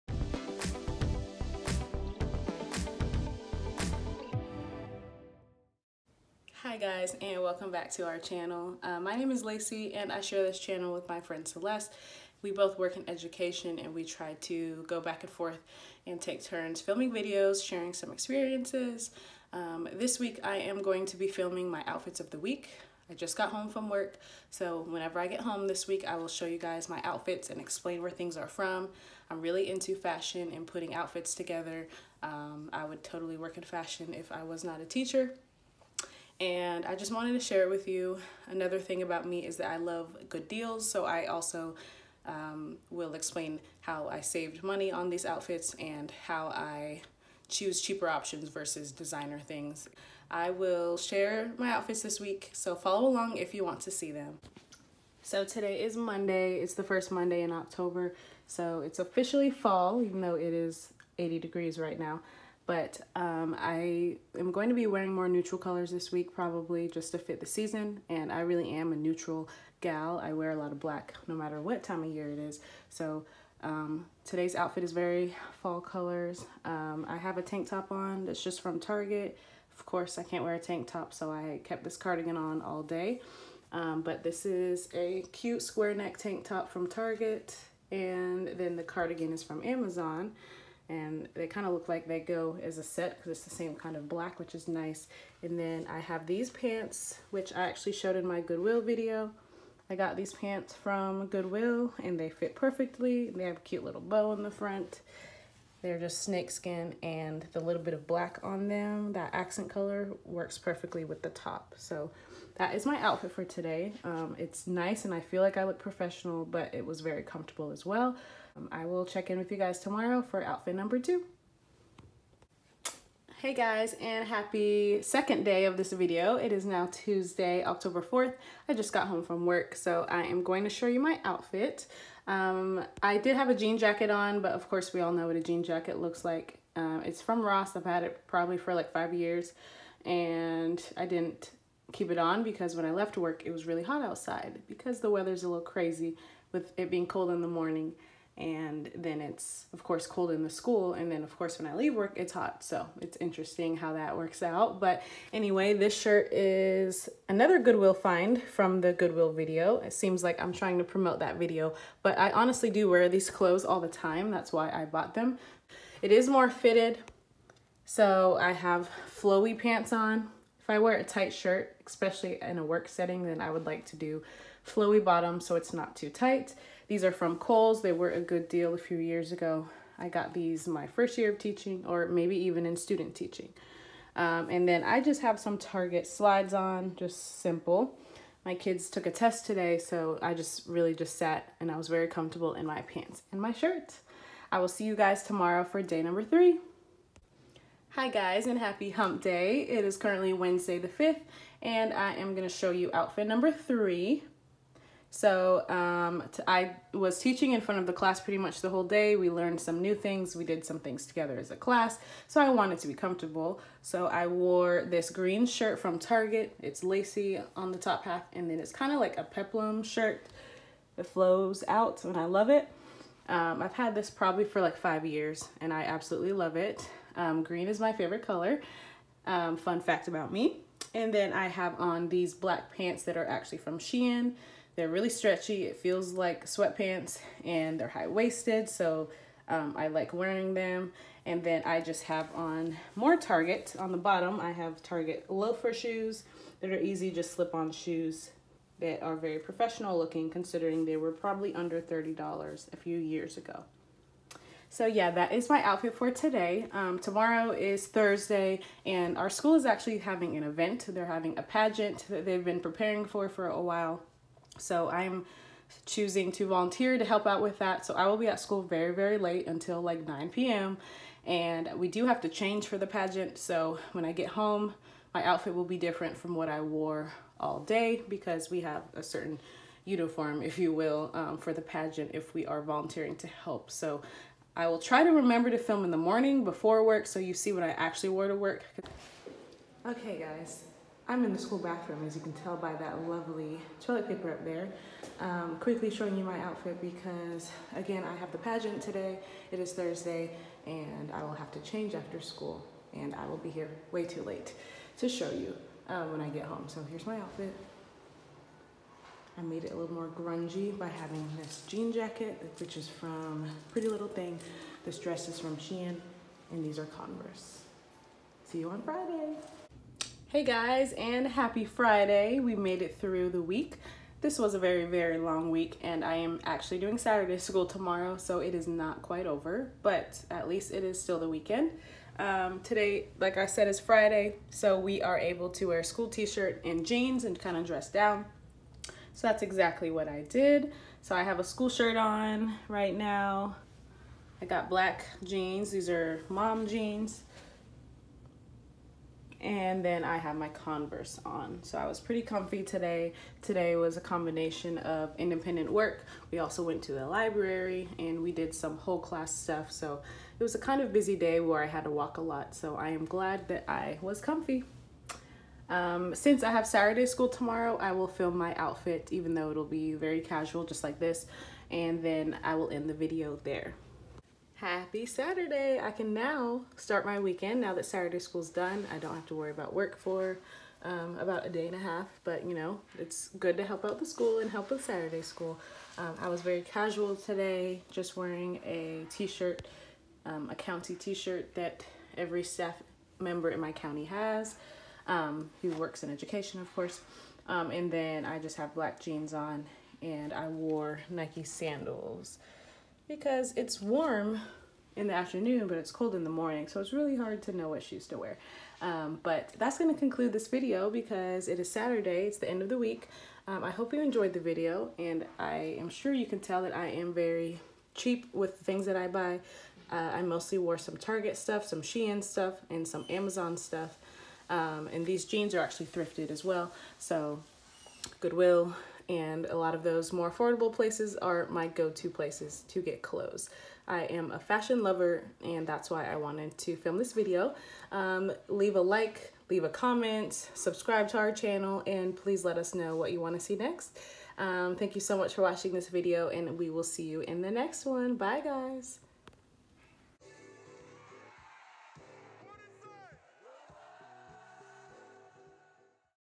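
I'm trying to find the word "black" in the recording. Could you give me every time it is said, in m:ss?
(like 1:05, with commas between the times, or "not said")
1:10, 1:34, 1:48, 3:52, 5:44, 6:38.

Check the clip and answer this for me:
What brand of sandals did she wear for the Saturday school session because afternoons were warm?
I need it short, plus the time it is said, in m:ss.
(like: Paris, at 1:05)
Nike, at 6:41.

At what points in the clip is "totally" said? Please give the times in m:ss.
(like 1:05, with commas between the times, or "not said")
0:33.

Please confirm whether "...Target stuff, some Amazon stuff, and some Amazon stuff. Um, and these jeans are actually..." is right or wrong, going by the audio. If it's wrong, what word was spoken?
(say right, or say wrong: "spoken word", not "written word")
wrong: "Shein", not "Amazon".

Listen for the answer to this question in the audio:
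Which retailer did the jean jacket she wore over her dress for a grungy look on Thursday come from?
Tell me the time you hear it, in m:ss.
5:13.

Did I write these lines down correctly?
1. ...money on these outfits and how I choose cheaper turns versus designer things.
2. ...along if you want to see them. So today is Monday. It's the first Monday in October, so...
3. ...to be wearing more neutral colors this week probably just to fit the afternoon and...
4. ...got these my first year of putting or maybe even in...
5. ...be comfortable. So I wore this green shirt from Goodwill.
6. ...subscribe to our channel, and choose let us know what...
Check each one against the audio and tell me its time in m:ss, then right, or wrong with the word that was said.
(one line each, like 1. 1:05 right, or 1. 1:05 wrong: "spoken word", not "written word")
1. 0:44 wrong: "options", not "turns"
2. 0:53 right
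3. 1:04 wrong: "season", not "afternoon"
4. 3:00 wrong: "teaching", not "putting"
5. 3:32 wrong: "Target", not "Goodwill"
6. 7:20 wrong: "please", not "choose".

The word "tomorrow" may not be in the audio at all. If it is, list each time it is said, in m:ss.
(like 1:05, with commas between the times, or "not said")
1:59, 3:15, 4:16, 5:27, 6:07.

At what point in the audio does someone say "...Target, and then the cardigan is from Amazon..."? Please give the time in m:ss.
1:26.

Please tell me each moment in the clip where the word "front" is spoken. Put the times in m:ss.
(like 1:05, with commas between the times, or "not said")
1:44, 3:27.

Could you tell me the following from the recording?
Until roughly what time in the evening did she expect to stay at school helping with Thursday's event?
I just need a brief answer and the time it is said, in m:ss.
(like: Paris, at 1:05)
9 p.m., at 4:30.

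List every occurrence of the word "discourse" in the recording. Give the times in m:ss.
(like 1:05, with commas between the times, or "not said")
not said.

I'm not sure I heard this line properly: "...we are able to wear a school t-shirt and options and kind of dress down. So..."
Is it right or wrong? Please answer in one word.
wrong.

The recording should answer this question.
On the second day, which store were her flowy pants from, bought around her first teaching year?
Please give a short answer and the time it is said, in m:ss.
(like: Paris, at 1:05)
Kohl's, at 2:56.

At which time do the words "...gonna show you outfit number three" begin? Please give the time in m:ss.
3:22.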